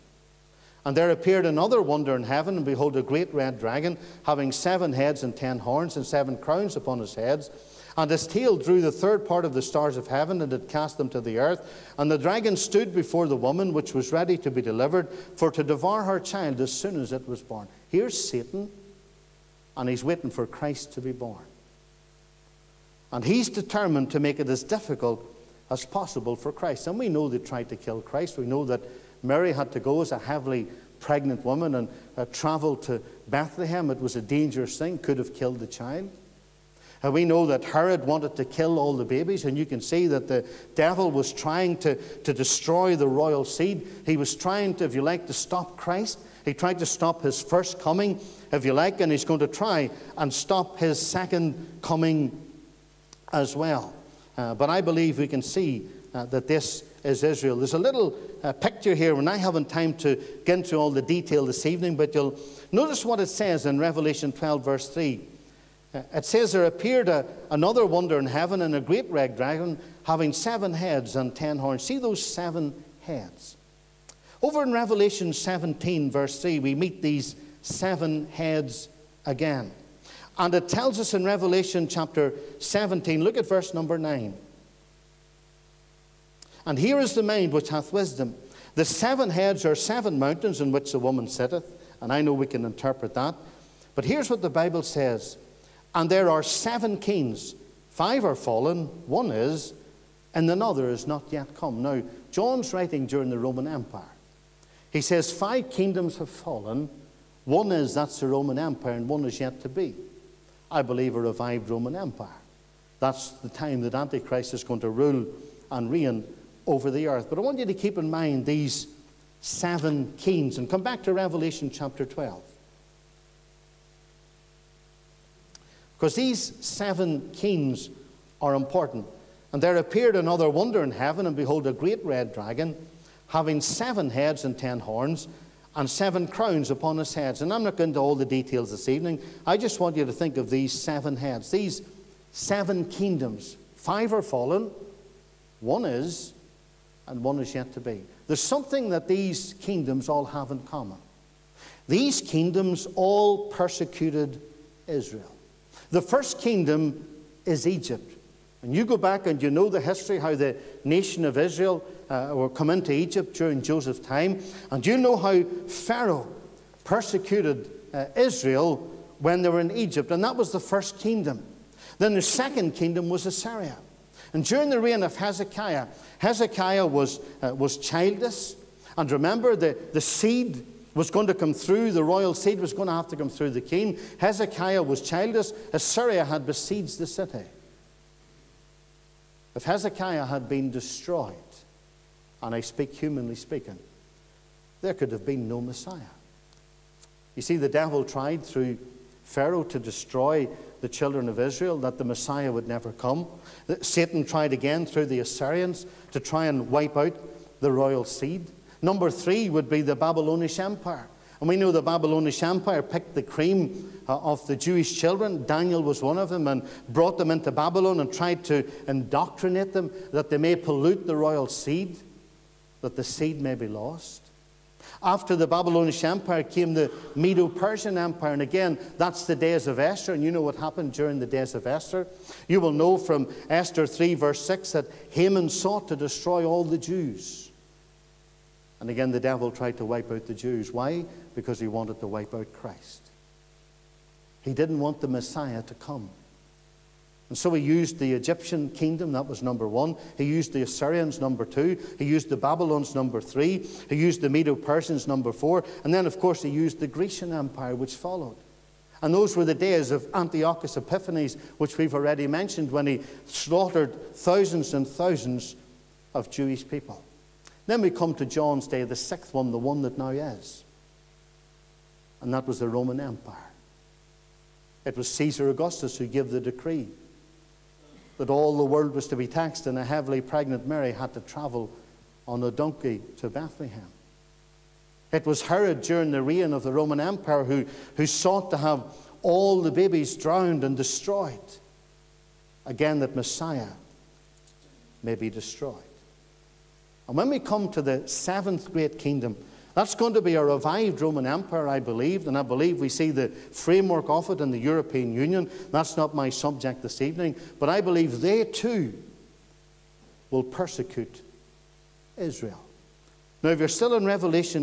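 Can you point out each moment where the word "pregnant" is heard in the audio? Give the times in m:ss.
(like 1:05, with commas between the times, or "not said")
0:30, 4:40.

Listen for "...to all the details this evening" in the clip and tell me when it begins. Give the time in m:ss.
2:17.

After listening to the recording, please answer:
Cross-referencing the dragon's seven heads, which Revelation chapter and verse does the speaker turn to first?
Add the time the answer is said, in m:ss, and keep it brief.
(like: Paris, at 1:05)
Revelation 17:3, at 1:14.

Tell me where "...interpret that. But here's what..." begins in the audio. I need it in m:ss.
1:32.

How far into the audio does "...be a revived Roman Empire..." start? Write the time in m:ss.
5:00.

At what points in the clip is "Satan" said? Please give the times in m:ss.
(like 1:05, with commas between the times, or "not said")
0:18, 3:23.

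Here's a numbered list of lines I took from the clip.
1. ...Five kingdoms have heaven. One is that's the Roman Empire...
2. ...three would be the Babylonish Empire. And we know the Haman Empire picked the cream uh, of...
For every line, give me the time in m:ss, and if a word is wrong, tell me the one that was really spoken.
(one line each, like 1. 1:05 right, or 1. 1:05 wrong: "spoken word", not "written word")
1. 1:45 wrong: "fallen", not "heaven"
2. 3:29 wrong: "Babylonish", not "Haman".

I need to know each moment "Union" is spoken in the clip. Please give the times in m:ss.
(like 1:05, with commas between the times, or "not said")
5:05.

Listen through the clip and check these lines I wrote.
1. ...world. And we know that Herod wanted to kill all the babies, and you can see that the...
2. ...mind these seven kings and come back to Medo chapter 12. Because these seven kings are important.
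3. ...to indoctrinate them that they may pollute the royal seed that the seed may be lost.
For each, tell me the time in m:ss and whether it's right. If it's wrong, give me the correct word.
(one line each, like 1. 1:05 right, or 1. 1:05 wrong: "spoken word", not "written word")
1. 0:35 wrong: "child", not "world"
2. 1:58 wrong: "Revelation", not "Medo"
3. 3:38 right.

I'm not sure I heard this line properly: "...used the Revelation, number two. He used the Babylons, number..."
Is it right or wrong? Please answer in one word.
wrong.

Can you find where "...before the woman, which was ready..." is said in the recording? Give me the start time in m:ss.
0:12.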